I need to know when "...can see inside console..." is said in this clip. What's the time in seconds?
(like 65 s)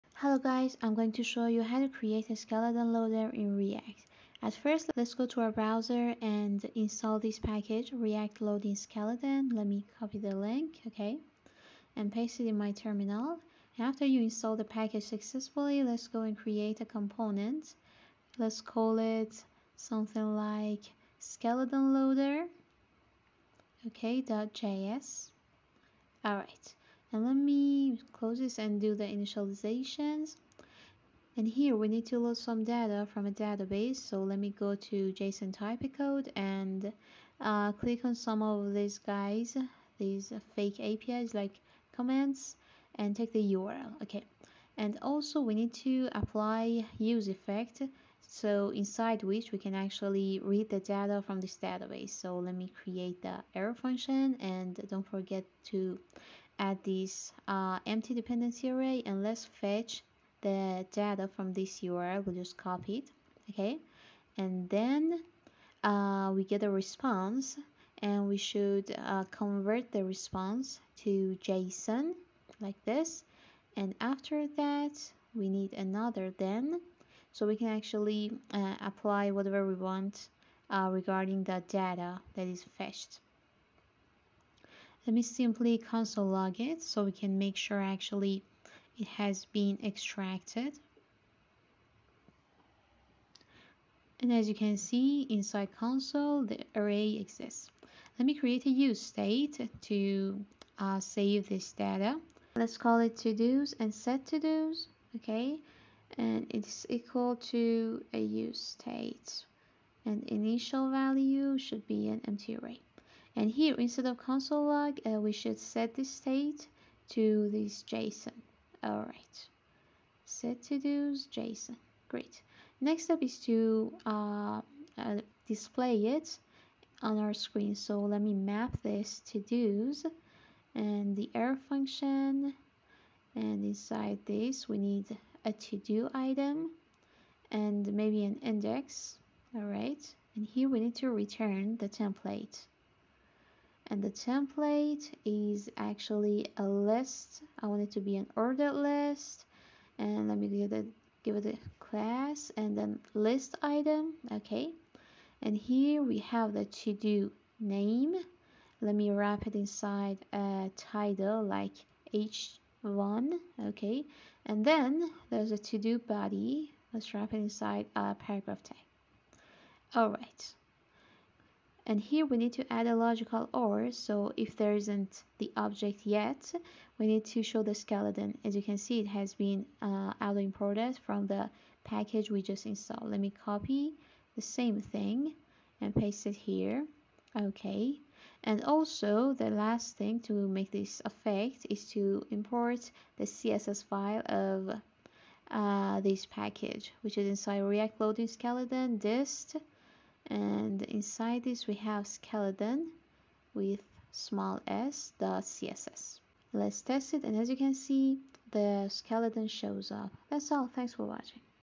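94 s.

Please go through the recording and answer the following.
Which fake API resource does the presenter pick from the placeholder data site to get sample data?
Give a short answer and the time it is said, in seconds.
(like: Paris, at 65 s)
comments, at 41 s.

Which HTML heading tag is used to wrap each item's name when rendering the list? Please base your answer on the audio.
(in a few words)
h1.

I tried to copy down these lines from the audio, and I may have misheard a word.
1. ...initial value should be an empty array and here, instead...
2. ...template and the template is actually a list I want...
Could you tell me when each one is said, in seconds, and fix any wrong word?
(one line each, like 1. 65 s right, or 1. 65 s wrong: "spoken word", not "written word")
1. 110 s right
2. 141 s right.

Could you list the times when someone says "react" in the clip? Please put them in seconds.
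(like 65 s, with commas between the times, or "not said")
3 s, 7 s, 197 s.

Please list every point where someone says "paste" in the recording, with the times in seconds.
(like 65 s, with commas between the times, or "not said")
12 s, 185 s.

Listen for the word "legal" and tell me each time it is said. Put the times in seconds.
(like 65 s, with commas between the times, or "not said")
not said.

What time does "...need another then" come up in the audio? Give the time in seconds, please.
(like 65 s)
75 s.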